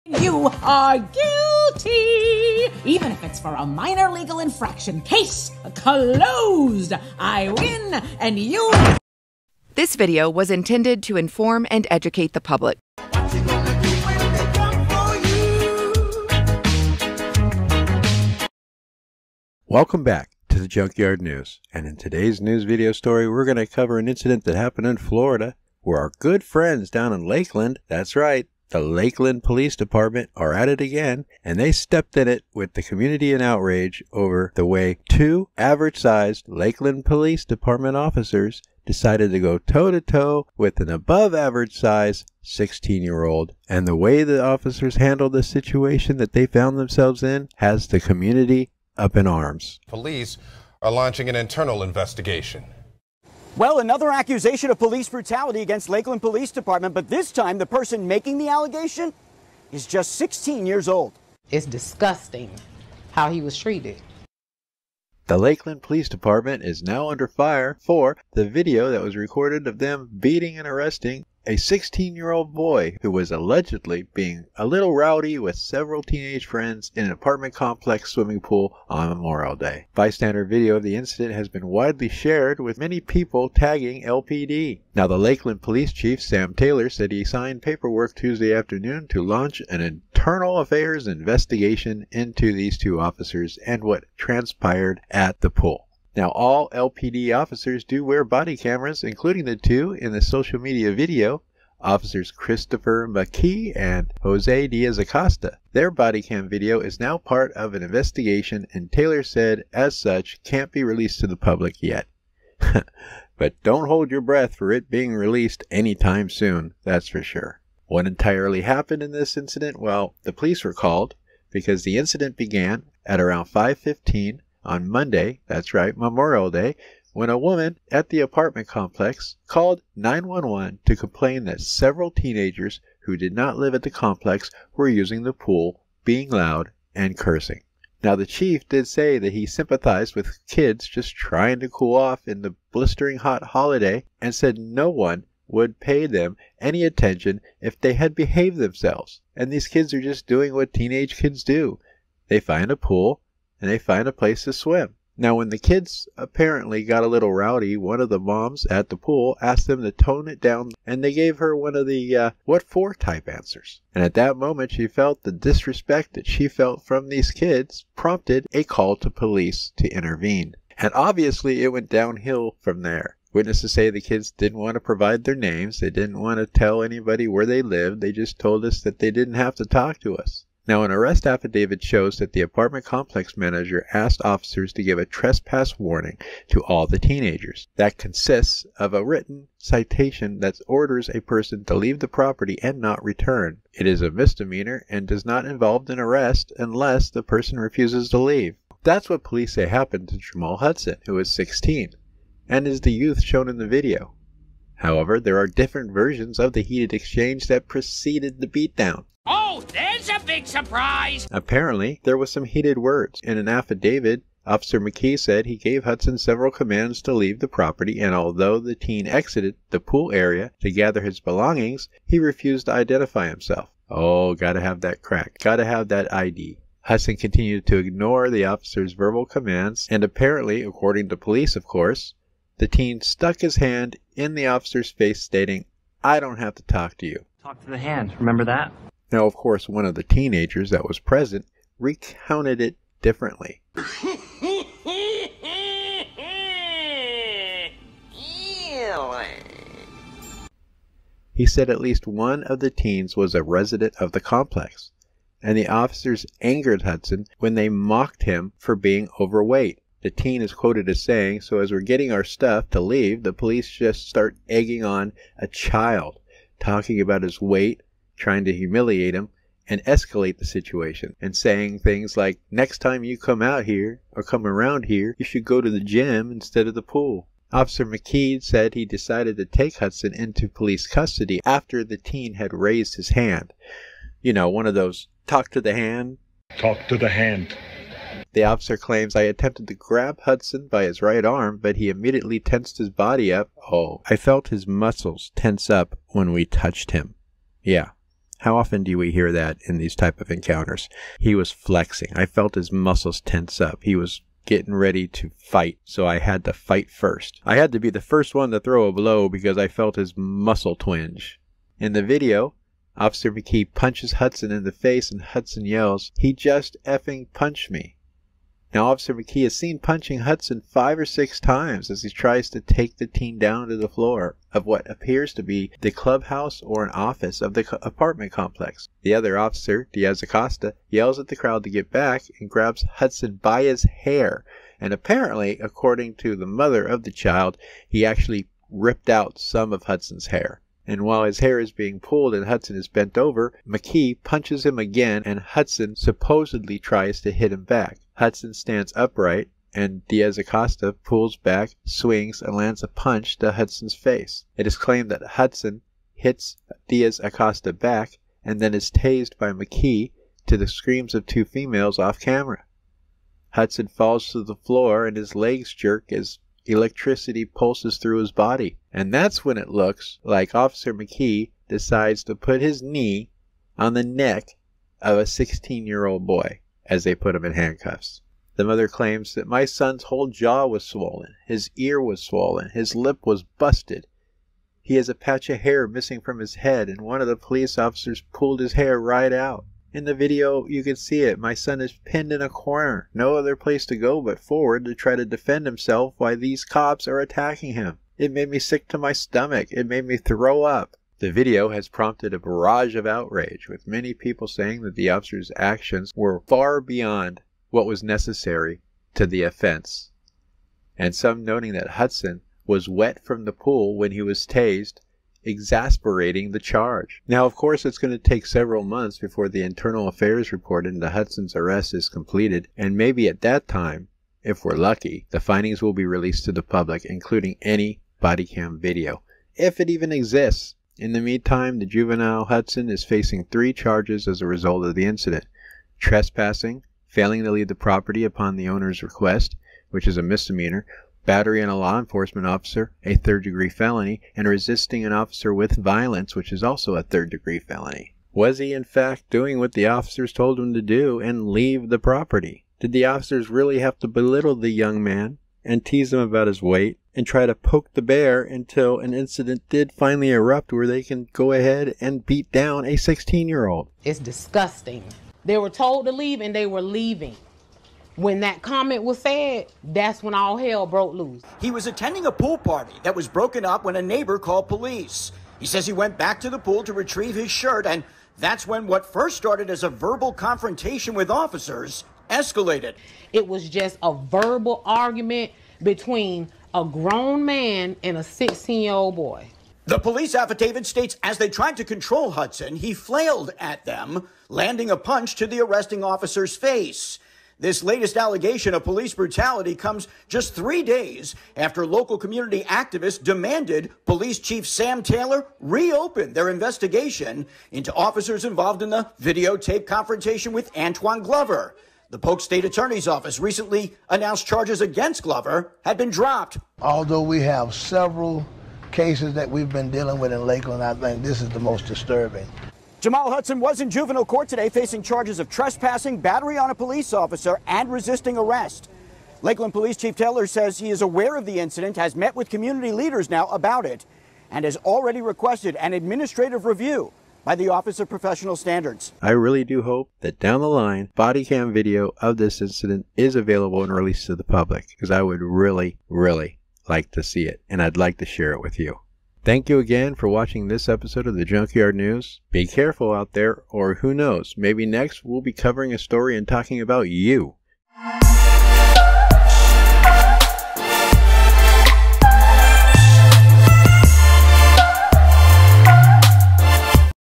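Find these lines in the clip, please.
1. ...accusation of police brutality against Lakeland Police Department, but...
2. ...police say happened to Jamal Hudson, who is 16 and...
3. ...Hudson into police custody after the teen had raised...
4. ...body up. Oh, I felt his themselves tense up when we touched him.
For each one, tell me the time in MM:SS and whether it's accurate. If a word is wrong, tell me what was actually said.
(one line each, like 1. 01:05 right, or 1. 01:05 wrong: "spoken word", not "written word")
1. 00:54 right
2. 03:19 right
3. 04:39 right
4. 04:52 wrong: "muscles", not "themselves".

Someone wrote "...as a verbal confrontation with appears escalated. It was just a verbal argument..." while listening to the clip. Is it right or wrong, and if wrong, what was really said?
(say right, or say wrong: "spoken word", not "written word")
wrong: "officers", not "appears".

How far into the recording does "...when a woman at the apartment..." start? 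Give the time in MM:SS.
02:07.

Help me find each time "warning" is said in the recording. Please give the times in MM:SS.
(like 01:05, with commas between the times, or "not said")
03:05.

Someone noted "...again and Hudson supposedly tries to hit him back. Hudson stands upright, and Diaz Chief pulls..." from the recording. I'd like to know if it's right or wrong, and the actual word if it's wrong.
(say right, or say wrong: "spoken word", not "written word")
wrong: "Acosta", not "Chief".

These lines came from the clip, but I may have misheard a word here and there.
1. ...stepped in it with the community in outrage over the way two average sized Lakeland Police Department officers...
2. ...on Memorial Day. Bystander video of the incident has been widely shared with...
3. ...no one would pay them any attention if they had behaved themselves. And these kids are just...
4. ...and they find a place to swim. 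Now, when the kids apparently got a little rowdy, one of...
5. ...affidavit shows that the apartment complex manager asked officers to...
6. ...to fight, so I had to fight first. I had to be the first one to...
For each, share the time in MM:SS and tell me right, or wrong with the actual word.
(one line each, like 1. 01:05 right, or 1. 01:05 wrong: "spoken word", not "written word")
1. 00:31 right
2. 01:18 right
3. 02:24 right
4. 02:33 right
5. 03:01 right
6. 05:05 right.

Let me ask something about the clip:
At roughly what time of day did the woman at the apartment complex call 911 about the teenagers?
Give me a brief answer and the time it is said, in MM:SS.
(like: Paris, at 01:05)
5:15, at 02:03.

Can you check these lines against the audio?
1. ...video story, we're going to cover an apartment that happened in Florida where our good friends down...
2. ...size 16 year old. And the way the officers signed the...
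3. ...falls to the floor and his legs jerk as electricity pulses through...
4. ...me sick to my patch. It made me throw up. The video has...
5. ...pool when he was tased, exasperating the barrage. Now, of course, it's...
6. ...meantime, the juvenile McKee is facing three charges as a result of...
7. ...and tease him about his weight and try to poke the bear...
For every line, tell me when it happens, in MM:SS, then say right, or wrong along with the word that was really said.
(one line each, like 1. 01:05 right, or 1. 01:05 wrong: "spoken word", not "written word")
1. 00:22 wrong: "incident", not "apartment"
2. 00:41 wrong: "handled", not "signed"
3. 06:03 right
4. 06:38 wrong: "stomach", not "patch"
5. 06:53 wrong: "charge", not "barrage"
6. 07:11 wrong: "Hudson", not "McKee"
7. 07:35 right.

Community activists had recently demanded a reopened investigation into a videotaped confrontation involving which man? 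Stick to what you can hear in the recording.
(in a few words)
Antoine Glover.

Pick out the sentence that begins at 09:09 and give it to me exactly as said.
Thank you again for watching this episode of the Junkyard News.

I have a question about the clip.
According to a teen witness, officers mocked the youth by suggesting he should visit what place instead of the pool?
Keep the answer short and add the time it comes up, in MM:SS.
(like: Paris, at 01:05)
the gym, at 04:35.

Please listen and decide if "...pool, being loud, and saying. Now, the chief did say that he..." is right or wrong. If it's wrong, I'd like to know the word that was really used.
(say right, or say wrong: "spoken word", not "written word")
wrong: "cursing", not "saying".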